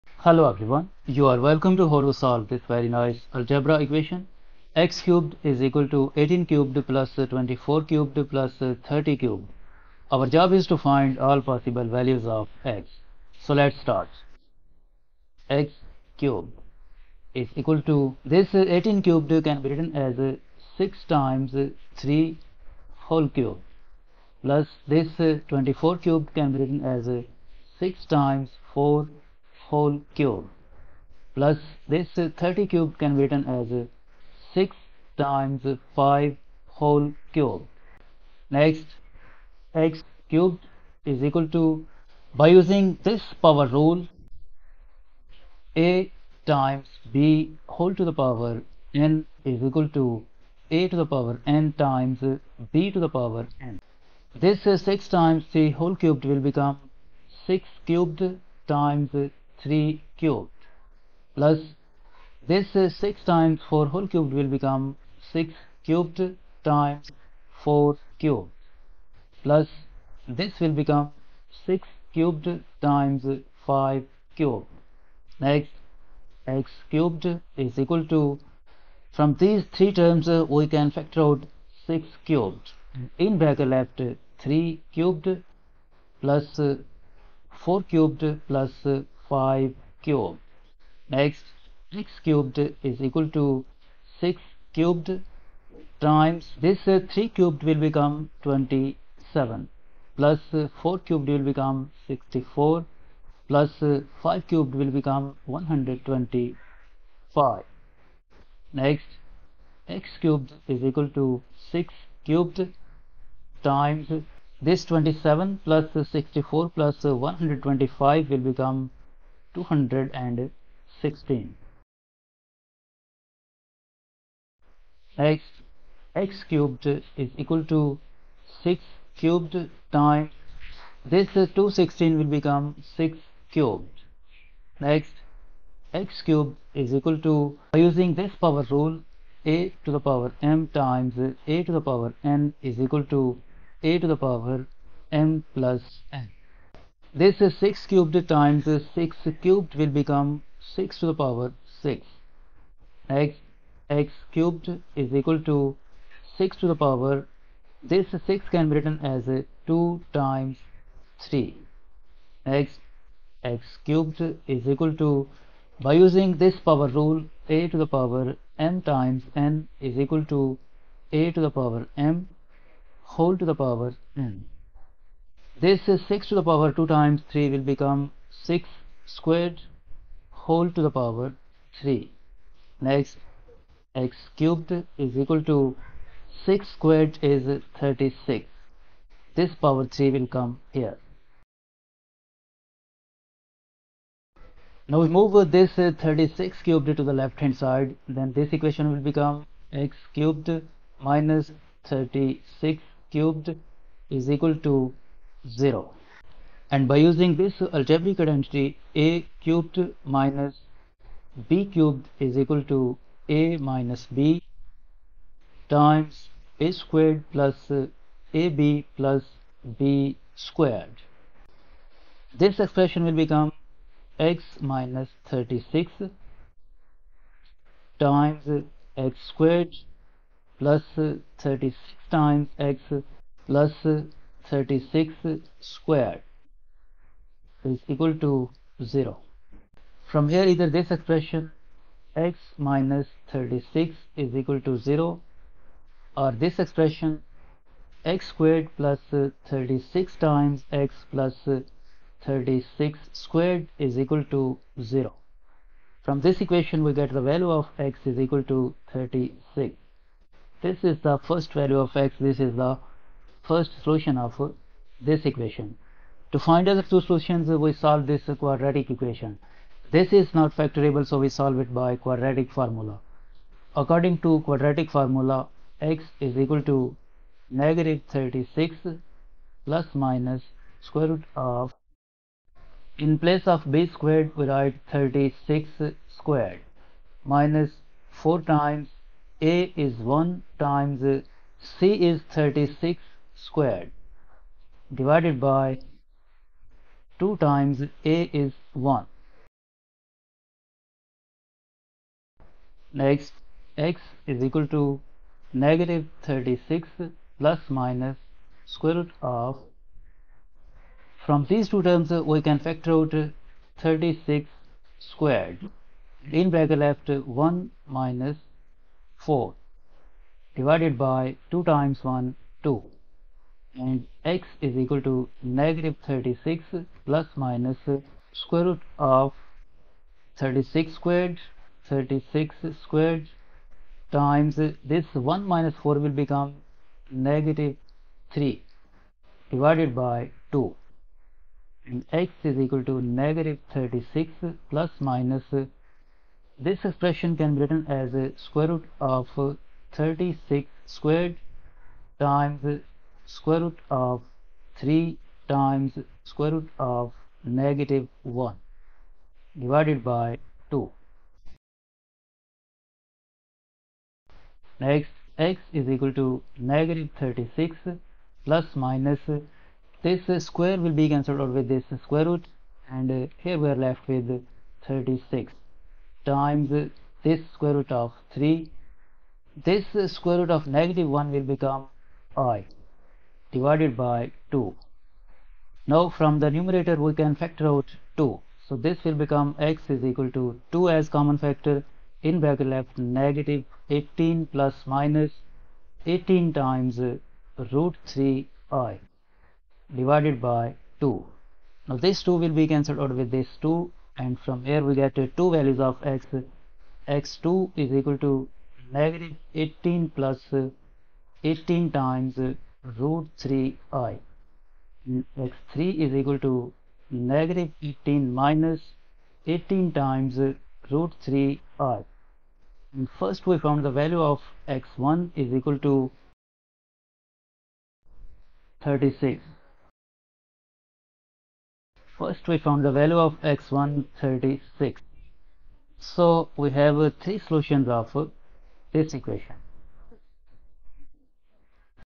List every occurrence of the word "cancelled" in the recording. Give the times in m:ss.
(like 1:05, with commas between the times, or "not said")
6:11, 6:42.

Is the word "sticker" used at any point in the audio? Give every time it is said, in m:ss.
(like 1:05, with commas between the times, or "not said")
not said.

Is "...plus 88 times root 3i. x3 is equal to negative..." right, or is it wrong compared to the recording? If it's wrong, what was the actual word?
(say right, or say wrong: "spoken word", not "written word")
wrong: "18", not "88".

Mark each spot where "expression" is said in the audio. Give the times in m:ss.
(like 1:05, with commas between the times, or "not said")
3:42, 4:00, 4:06, 5:46.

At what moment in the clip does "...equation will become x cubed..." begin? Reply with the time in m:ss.
3:18.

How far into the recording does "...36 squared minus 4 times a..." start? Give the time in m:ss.
4:44.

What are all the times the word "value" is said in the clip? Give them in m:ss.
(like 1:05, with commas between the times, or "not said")
0:11, 4:17, 4:21, 6:45, 7:03, 7:12.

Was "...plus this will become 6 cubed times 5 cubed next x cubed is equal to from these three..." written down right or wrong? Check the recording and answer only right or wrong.
right.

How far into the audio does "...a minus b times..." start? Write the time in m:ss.
3:33.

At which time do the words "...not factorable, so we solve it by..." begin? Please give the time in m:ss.
4:30.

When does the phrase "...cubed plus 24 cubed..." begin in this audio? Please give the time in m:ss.
0:06.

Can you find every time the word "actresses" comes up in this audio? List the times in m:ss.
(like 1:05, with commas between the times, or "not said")
not said.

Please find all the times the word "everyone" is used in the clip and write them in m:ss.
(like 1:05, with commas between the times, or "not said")
0:00.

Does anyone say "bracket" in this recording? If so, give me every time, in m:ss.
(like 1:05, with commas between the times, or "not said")
1:23, 5:16, 6:32.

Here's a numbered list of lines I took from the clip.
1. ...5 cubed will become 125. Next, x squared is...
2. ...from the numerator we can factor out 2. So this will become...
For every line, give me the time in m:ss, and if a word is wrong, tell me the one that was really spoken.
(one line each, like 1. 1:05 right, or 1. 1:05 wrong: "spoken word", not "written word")
1. 1:44 wrong: "cubed", not "squared"
2. 6:26 right.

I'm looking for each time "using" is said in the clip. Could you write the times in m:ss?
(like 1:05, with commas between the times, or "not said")
0:42, 2:17, 2:46, 3:26.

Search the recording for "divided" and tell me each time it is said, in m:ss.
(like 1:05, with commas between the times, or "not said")
4:54, 5:20, 5:39, 5:59, 6:23, 6:39.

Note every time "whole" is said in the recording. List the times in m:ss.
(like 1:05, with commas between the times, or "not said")
0:23, 0:29, 0:36, 0:47, 0:55, 1:03, 2:53, 3:00.